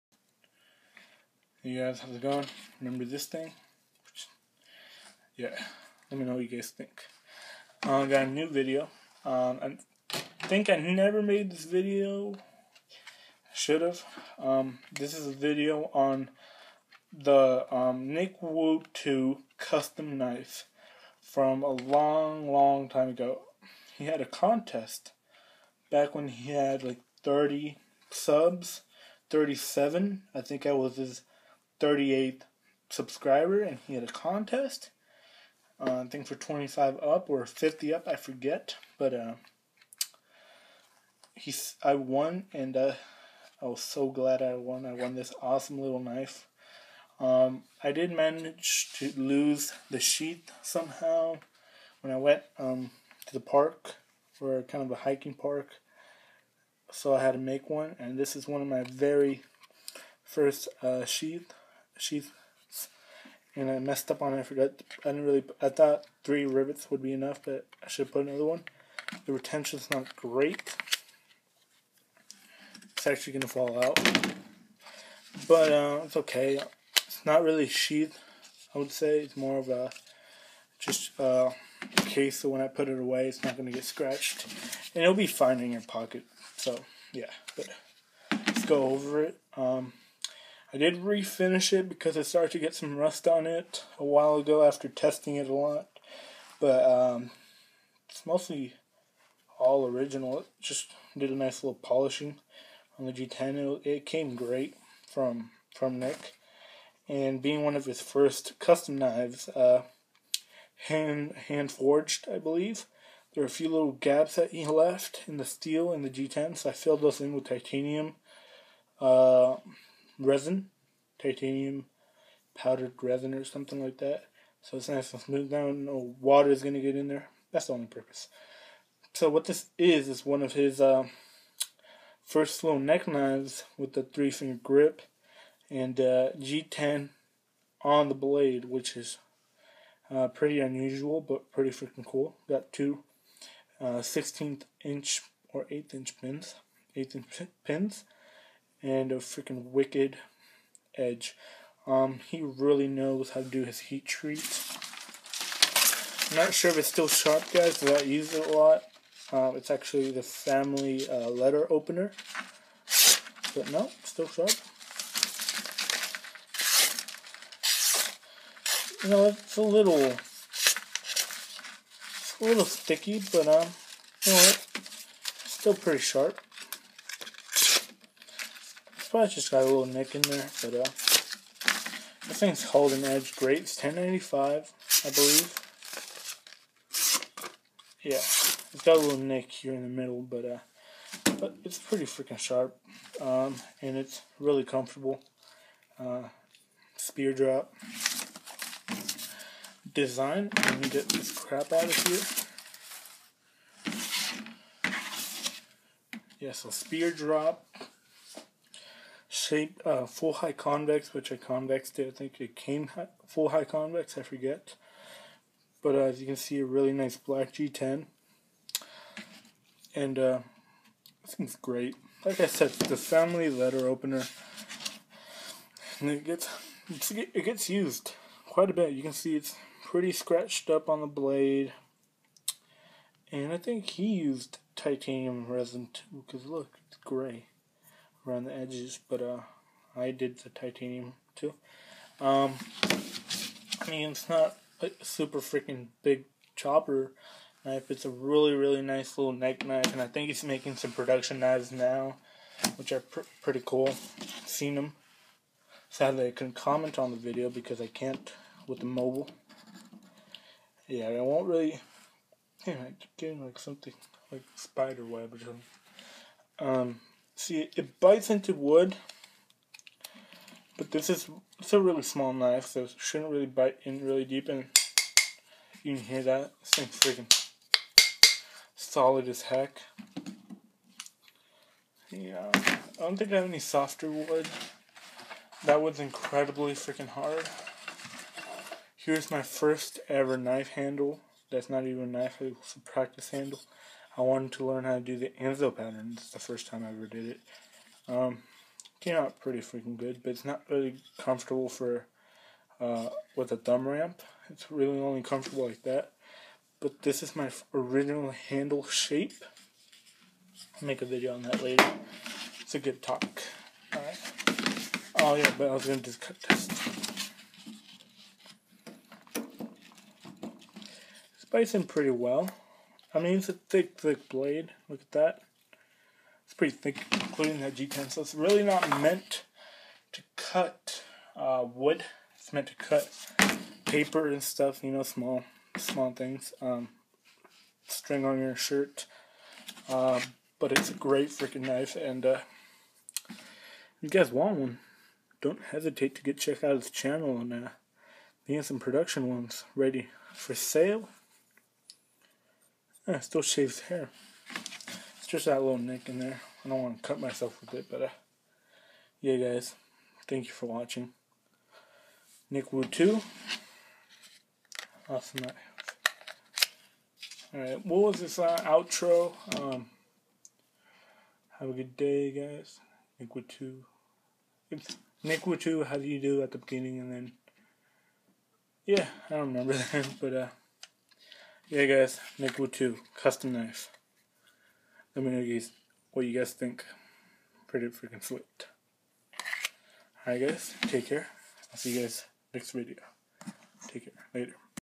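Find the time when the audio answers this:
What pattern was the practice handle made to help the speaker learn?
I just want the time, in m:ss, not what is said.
4:55.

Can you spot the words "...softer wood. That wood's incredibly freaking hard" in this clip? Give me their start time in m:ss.
4:43.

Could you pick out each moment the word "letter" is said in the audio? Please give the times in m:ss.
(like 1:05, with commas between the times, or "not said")
2:41, 3:43.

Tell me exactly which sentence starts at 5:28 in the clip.
So it's really not meant to cut uh, wood.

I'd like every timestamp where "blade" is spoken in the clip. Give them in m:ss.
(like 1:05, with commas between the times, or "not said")
2:18, 3:51, 5:24.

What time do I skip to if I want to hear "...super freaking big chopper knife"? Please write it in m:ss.
4:05.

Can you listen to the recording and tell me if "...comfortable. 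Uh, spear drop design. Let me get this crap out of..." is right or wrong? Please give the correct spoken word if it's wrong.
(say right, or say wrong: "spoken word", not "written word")
right.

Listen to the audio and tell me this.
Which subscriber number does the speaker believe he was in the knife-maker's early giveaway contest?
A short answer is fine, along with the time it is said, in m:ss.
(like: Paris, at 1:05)
38th, at 0:31.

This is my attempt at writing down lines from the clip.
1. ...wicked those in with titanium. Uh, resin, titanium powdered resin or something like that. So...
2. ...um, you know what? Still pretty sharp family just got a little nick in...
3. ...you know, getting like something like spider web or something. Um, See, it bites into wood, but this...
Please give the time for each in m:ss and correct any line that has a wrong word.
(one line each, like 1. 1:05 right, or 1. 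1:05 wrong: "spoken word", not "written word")
1. 1:56 wrong: "filled", not "wicked"
2. 2:53 wrong: "probably", not "family"
3. 4:22 right.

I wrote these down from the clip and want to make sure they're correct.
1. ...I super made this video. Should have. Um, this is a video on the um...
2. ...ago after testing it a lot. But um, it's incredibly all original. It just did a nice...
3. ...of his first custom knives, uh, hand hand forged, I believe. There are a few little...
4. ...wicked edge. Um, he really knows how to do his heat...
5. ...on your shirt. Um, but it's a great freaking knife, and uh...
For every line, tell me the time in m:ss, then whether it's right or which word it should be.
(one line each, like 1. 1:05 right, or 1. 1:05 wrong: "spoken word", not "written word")
1. 0:10 wrong: "never", not "super"
2. 1:34 wrong: "mostly", not "incredibly"
3. 1:47 right
4. 2:29 right
5. 5:38 right.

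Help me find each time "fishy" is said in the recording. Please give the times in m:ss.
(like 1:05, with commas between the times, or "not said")
not said.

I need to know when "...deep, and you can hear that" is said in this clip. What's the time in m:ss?
4:34.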